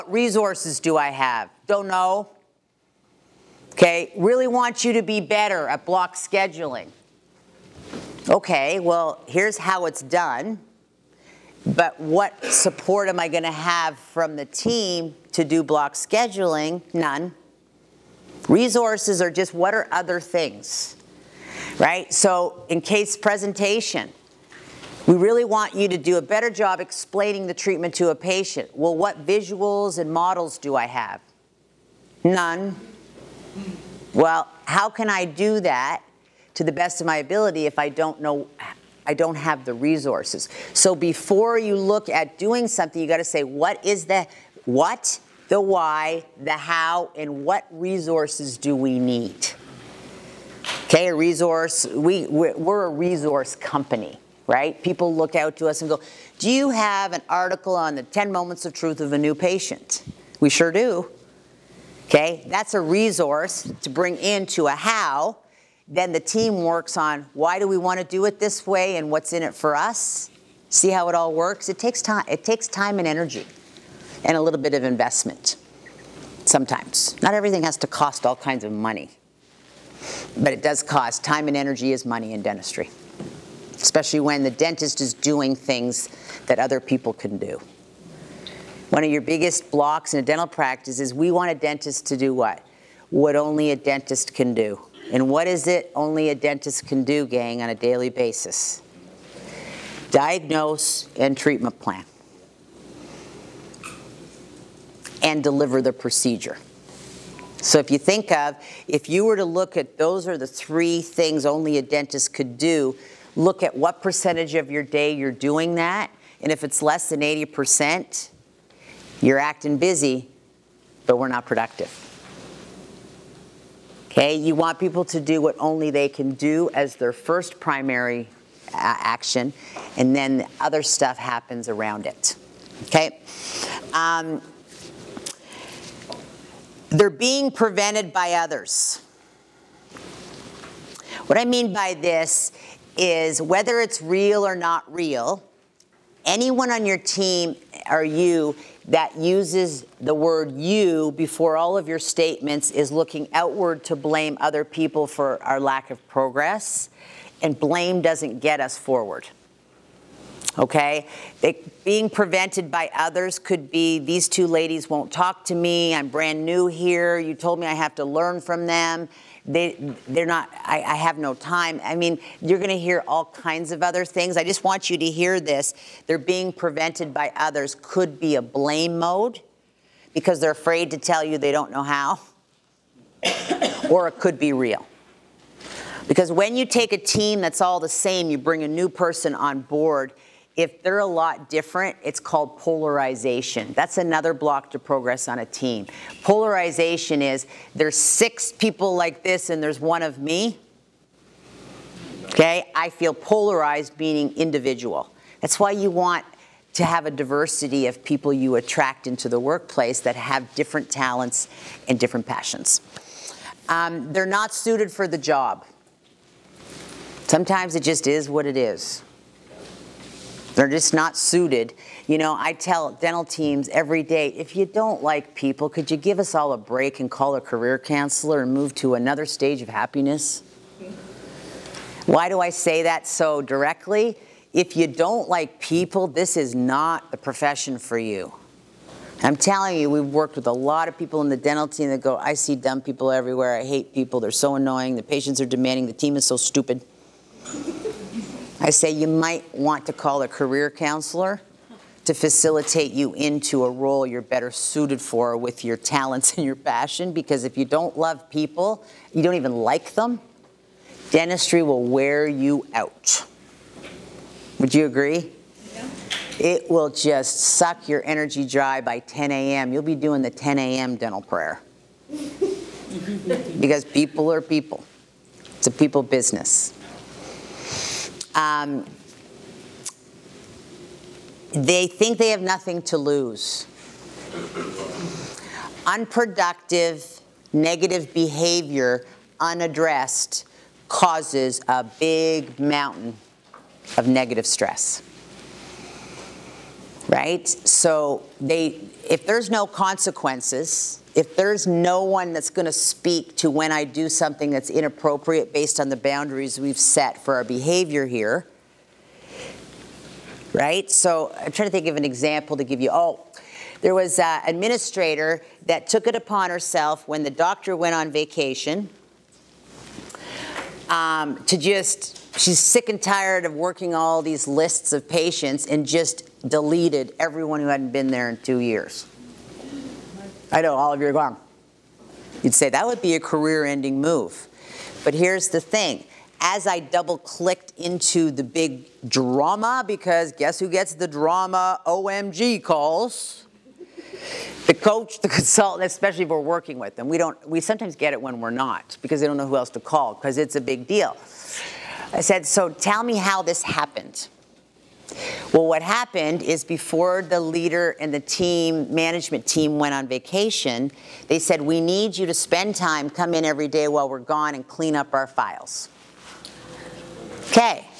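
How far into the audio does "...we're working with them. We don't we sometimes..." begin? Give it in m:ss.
5:46.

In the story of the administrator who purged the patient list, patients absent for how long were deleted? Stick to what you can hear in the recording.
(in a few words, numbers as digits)
2 years.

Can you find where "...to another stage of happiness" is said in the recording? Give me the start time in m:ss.
3:48.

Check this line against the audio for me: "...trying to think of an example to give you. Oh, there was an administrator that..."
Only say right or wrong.
right.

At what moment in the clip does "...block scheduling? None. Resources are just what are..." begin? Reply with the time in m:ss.
0:15.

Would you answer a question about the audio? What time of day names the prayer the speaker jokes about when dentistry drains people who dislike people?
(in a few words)
10 a.m.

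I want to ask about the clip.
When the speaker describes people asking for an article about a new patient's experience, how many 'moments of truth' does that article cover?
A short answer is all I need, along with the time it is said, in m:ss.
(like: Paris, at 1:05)
10, at 0:58.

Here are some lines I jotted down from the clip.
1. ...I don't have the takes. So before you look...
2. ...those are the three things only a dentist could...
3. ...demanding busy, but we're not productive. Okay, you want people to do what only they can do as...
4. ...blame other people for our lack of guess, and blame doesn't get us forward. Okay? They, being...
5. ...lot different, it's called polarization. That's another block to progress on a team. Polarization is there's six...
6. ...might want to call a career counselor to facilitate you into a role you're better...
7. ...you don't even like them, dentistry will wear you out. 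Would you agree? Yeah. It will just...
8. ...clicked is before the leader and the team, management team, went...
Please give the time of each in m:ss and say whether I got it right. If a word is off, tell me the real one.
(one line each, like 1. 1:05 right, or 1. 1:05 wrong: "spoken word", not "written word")
1. 0:39 wrong: "resources", not "takes"
2. 1:49 right
3. 1:59 wrong: "acting", not "demanding"
4. 2:33 wrong: "progress", not "guess"
5. 3:11 right
6. 4:09 right
7. 4:19 right
8. 5:55 wrong: "happened", not "clicked".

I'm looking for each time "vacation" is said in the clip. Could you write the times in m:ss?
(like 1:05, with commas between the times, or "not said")
5:18, 6:00.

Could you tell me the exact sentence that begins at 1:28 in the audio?
One of your biggest blocks in a dental practice is we want a dentist to do what?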